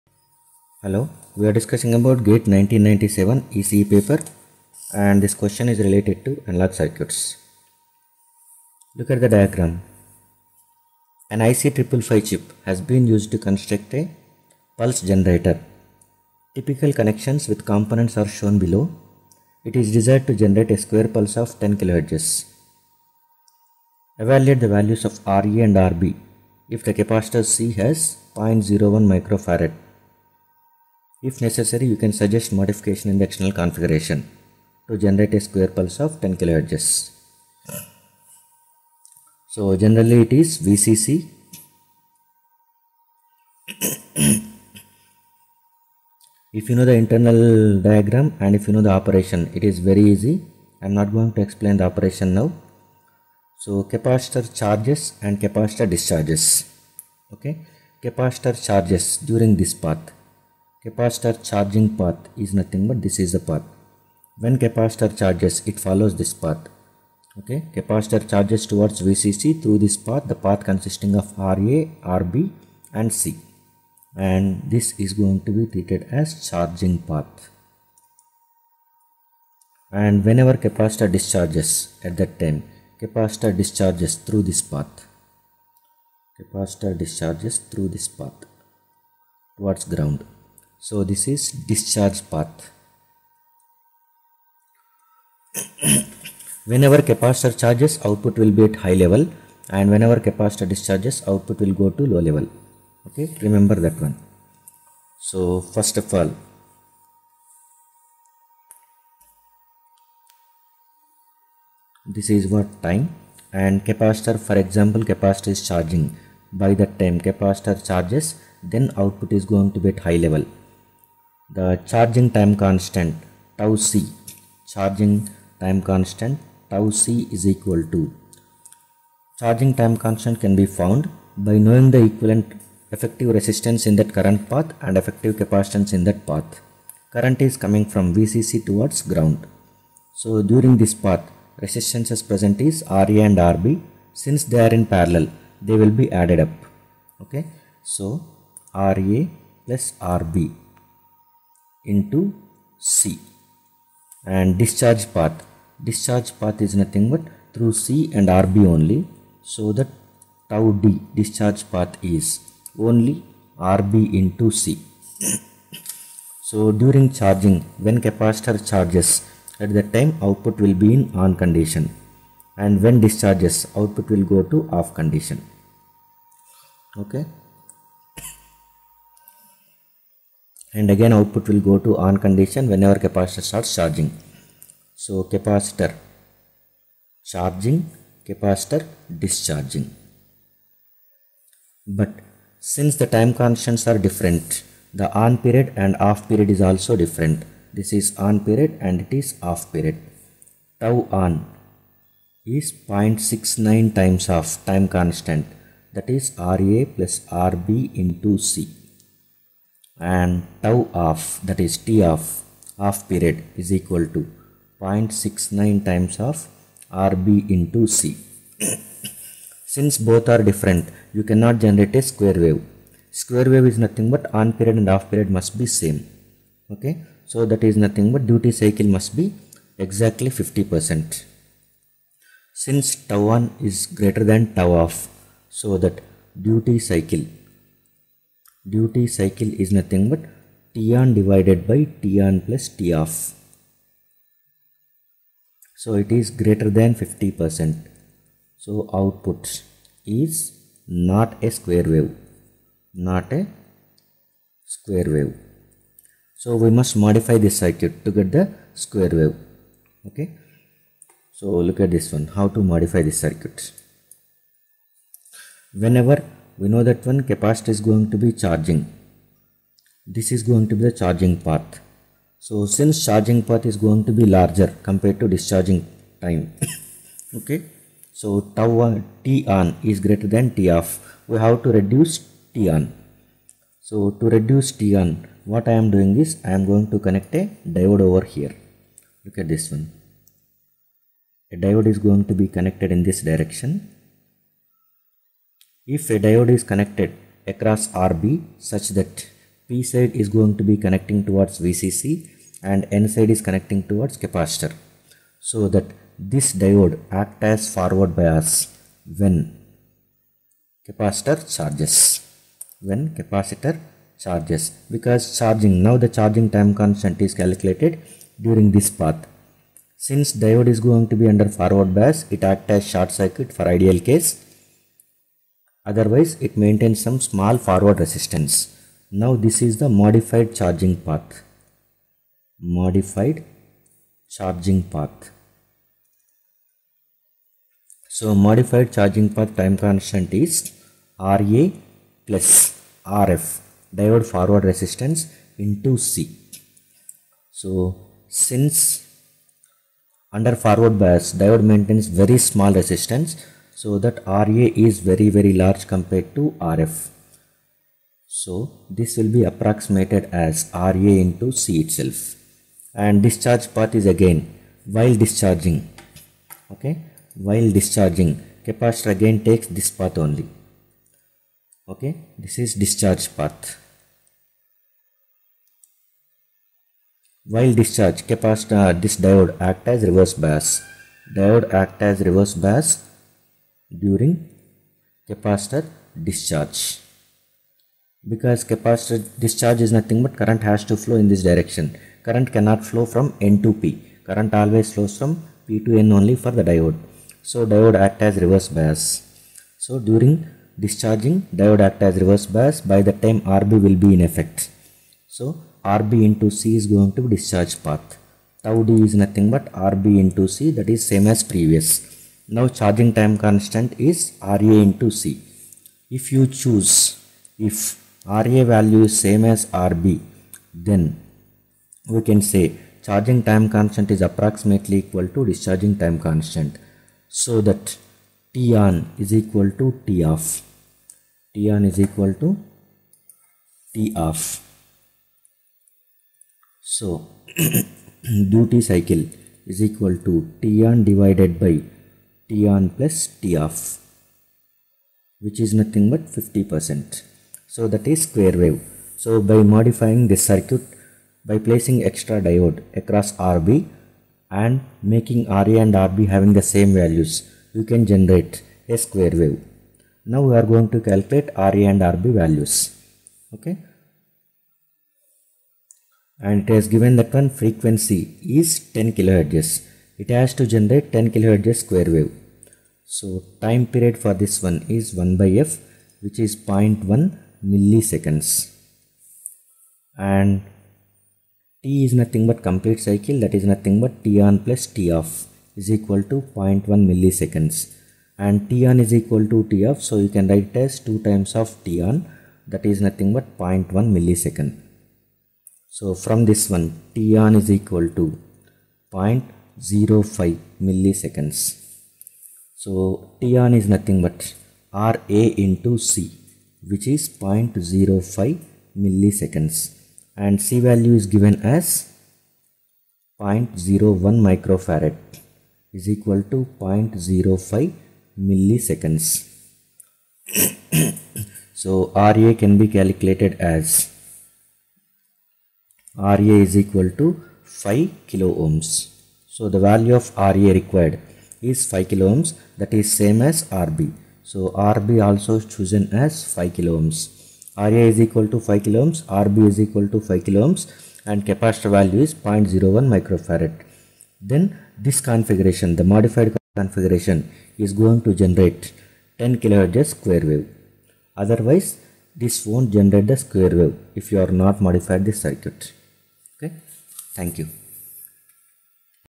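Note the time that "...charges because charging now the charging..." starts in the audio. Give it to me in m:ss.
5:14.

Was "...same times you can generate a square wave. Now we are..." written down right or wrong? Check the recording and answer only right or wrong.
wrong.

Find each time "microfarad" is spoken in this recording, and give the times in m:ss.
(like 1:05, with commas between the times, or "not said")
0:29, 8:34, 9:03.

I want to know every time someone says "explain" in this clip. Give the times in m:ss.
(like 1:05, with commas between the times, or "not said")
0:51.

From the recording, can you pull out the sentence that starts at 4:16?
So we must modify this circuit to get the square wave.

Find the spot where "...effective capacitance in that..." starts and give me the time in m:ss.
2:15.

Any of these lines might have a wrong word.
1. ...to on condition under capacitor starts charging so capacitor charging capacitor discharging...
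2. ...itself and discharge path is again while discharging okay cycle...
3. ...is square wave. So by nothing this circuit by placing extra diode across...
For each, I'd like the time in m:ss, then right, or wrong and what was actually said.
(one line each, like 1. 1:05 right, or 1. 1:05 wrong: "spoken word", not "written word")
1. 3:01 wrong: "whenever", not "under"
2. 6:01 wrong: "while", not "cycle"
3. 7:28 wrong: "modifying", not "nothing".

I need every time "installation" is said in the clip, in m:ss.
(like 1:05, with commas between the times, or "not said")
not said.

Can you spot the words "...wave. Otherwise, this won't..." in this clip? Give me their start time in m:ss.
9:10.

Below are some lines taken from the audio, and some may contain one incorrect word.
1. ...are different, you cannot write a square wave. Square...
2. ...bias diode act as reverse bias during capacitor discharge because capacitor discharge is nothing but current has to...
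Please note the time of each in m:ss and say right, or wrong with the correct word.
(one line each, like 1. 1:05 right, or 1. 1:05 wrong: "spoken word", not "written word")
1. 3:40 wrong: "generate", not "write"
2. 6:20 right.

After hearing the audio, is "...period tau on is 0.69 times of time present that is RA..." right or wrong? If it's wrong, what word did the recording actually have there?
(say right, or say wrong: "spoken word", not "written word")
wrong: "constant", not "present".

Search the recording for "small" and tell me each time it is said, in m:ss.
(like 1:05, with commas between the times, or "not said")
5:27, 5:52.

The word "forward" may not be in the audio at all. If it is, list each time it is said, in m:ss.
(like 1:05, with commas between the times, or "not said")
5:07, 5:21, 5:27, 5:44, 5:50.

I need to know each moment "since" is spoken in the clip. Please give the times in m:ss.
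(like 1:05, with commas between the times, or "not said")
2:24, 3:12, 3:39, 3:52, 4:32, 5:19, 5:48.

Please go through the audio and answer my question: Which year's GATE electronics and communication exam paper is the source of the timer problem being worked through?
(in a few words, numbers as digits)
1997.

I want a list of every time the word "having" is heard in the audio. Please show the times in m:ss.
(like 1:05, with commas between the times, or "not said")
7:36.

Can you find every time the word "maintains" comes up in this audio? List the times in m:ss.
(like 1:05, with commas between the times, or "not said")
5:26, 5:51.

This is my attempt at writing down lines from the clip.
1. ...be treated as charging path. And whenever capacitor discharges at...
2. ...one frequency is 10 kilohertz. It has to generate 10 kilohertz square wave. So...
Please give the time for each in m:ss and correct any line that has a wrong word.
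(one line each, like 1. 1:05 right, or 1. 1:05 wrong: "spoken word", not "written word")
1. 1:15 right
2. 7:47 right.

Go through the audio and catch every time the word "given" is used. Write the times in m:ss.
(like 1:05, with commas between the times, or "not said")
7:46, 8:31.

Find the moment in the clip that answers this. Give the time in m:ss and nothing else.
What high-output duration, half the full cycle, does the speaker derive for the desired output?
8:17.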